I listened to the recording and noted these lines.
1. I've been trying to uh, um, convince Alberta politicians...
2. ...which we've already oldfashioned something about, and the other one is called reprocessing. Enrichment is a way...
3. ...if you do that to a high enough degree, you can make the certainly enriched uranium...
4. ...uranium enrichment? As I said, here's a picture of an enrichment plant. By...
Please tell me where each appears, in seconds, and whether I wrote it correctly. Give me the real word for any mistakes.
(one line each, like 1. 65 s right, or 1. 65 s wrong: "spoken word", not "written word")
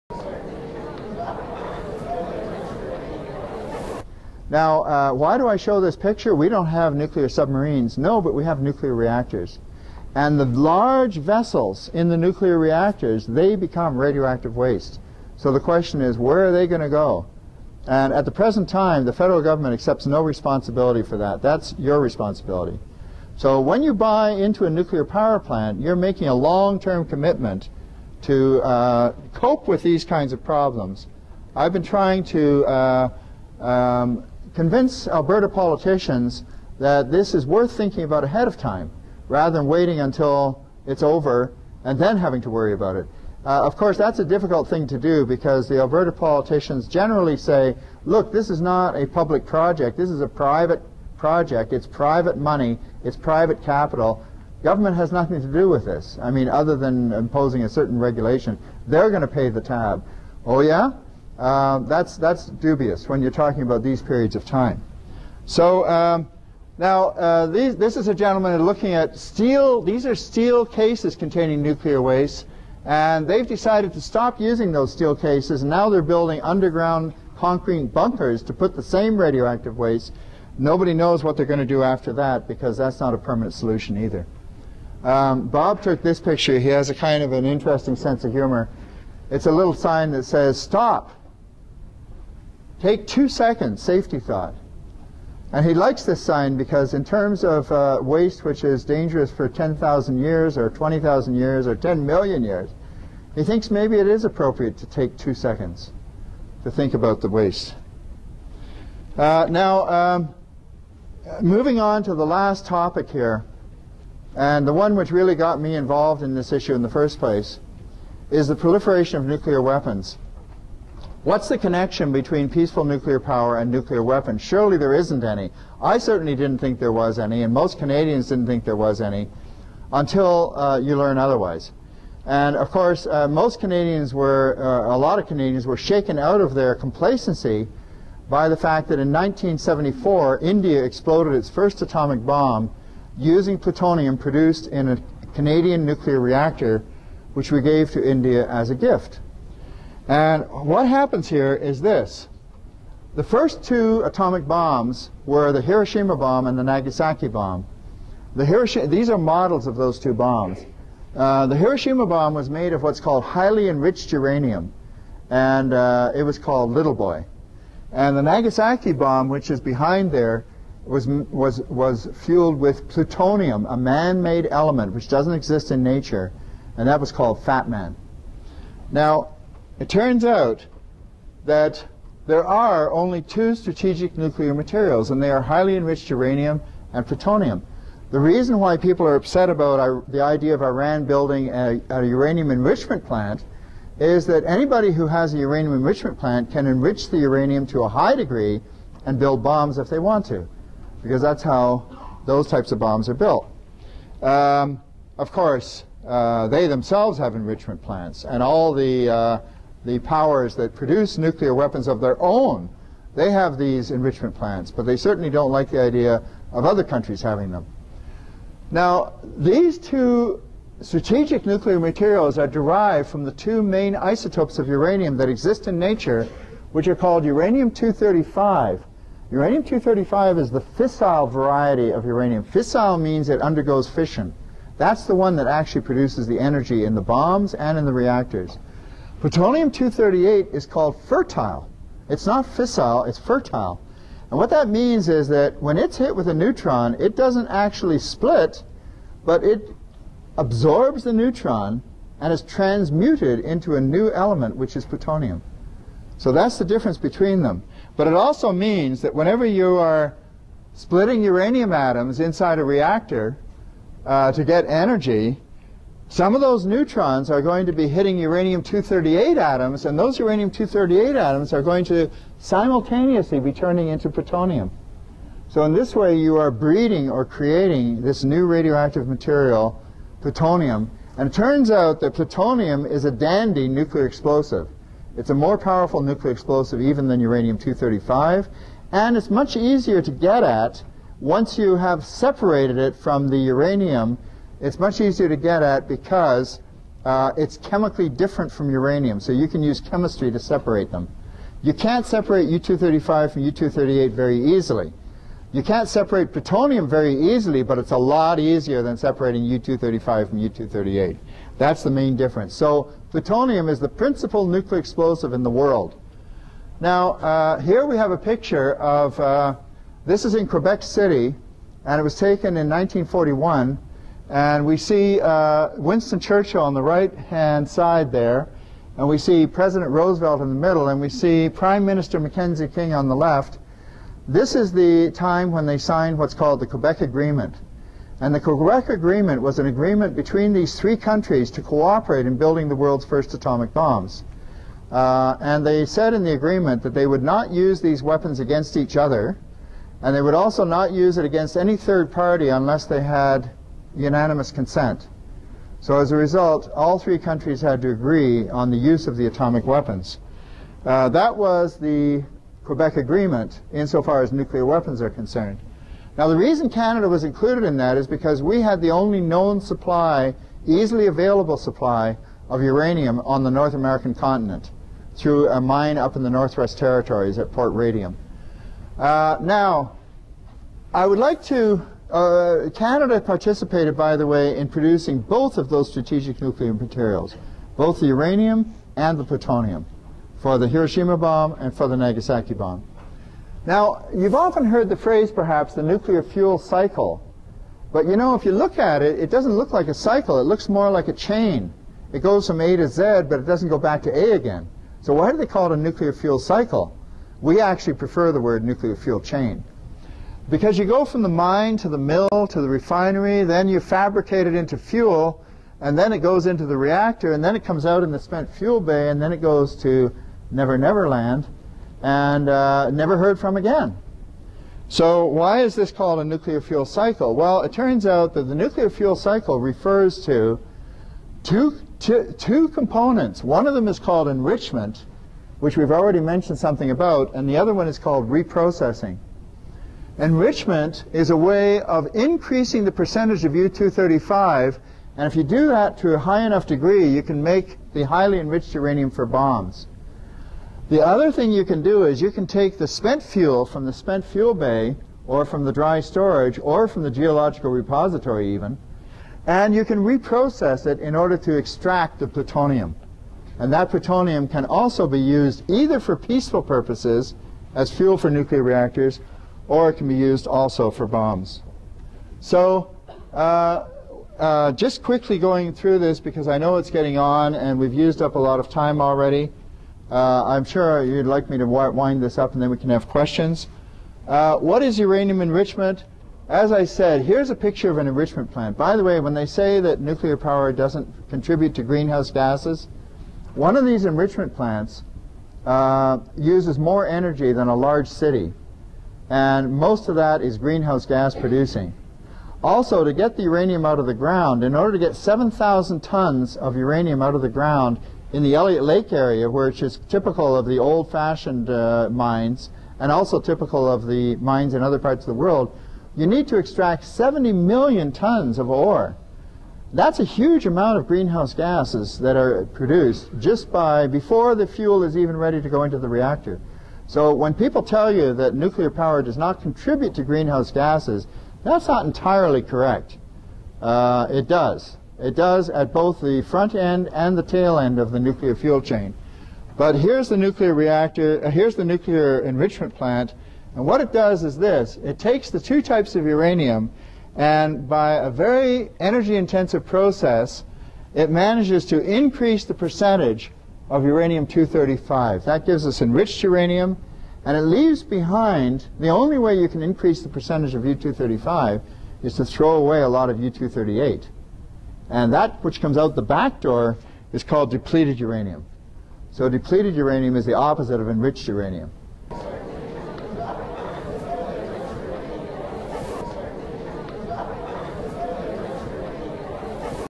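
1. 31 s right
2. 435 s wrong: "mentioned", not "oldfashioned"
3. 445 s wrong: "highly", not "certainly"
4. 484 s right.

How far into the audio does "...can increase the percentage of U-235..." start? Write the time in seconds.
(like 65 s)
559 s.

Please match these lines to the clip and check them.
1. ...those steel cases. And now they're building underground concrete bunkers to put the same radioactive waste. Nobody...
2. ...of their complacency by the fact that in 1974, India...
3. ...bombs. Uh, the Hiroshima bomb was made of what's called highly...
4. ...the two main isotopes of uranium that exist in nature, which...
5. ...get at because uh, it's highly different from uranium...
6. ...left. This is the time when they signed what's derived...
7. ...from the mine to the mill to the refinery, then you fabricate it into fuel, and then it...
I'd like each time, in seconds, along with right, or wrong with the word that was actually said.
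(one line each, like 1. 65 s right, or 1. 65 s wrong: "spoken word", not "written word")
1. 74 s right
2. 136 s right
3. 160 s right
4. 223 s right
5. 295 s wrong: "chemically", not "highly"
6. 333 s wrong: "called", not "derived"
7. 411 s right.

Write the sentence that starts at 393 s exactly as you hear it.
Now, you've often heard the phrase, perhaps, the nuclear fuel cycle.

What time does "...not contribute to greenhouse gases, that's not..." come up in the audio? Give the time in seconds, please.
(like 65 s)
529 s.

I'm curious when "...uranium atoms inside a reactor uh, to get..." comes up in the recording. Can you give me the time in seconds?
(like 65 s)
261 s.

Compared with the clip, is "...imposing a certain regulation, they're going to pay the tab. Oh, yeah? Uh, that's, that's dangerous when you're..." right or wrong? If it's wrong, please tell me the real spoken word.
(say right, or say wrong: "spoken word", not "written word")
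wrong: "dubious", not "dangerous".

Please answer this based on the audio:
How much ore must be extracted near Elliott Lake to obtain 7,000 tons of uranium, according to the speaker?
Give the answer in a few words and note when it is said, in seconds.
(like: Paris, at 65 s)
70 million tons, at 517 s.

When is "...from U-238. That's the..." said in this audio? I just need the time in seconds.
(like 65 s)
310 s.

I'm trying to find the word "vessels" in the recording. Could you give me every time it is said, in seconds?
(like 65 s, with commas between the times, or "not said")
11 s.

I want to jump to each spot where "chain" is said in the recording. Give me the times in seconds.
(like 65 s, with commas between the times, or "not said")
401 s, 409 s, 538 s.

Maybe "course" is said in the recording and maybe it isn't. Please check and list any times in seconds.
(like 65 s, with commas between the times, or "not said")
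43 s, 132 s, 205 s.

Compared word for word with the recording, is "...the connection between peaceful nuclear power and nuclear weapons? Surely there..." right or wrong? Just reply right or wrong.
right.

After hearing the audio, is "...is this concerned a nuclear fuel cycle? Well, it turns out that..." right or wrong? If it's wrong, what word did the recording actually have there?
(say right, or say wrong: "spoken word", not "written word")
wrong: "called", not "concerned".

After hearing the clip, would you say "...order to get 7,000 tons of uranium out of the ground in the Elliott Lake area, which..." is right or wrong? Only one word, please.
right.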